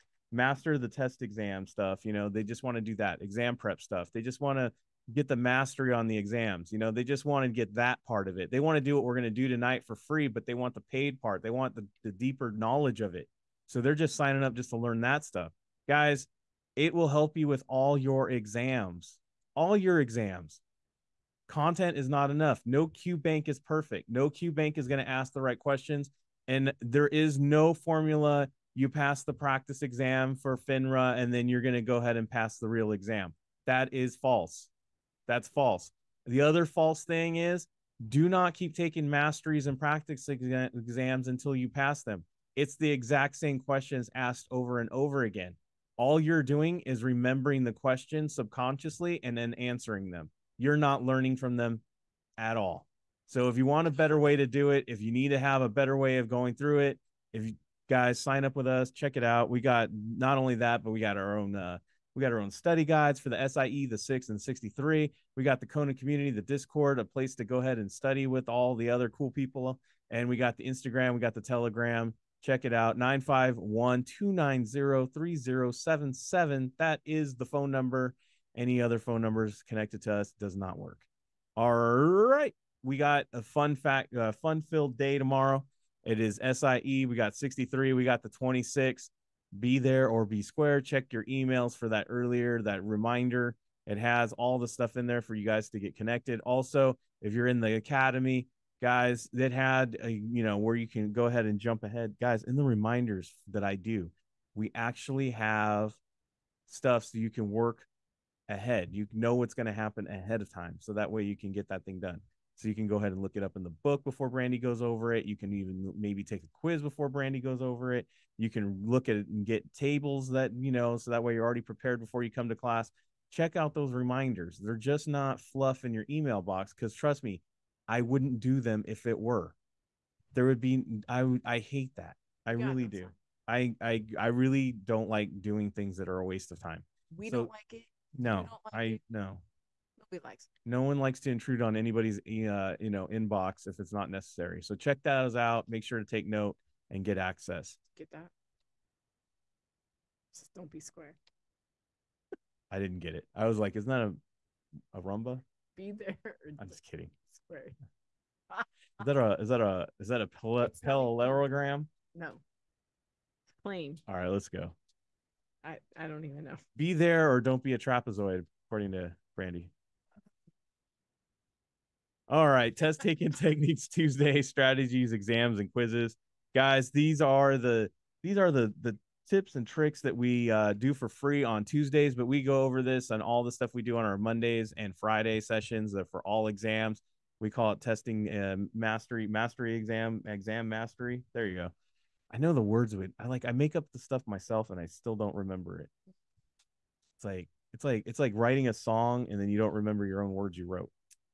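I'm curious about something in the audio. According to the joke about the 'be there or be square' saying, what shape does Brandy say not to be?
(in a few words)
trapezoid.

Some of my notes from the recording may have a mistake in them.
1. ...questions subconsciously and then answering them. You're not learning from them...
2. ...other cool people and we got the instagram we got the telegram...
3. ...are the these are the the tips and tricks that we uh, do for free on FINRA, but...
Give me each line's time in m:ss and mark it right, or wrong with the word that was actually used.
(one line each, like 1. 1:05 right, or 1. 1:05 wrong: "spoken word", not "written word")
1. 0:47 right
2. 1:08 right
3. 2:57 wrong: "Tuesdays", not "FINRA".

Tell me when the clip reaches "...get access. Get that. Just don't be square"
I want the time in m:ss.
2:27.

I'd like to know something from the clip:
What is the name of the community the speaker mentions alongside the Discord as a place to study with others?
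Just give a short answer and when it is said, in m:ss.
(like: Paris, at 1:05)
Kona community, at 1:05.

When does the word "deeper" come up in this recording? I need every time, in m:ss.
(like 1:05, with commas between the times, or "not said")
0:12.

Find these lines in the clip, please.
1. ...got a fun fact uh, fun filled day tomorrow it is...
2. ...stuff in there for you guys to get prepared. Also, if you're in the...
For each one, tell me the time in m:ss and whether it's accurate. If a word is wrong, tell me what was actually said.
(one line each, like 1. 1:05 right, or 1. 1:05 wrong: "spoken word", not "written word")
1. 1:22 right
2. 1:34 wrong: "connected", not "prepared".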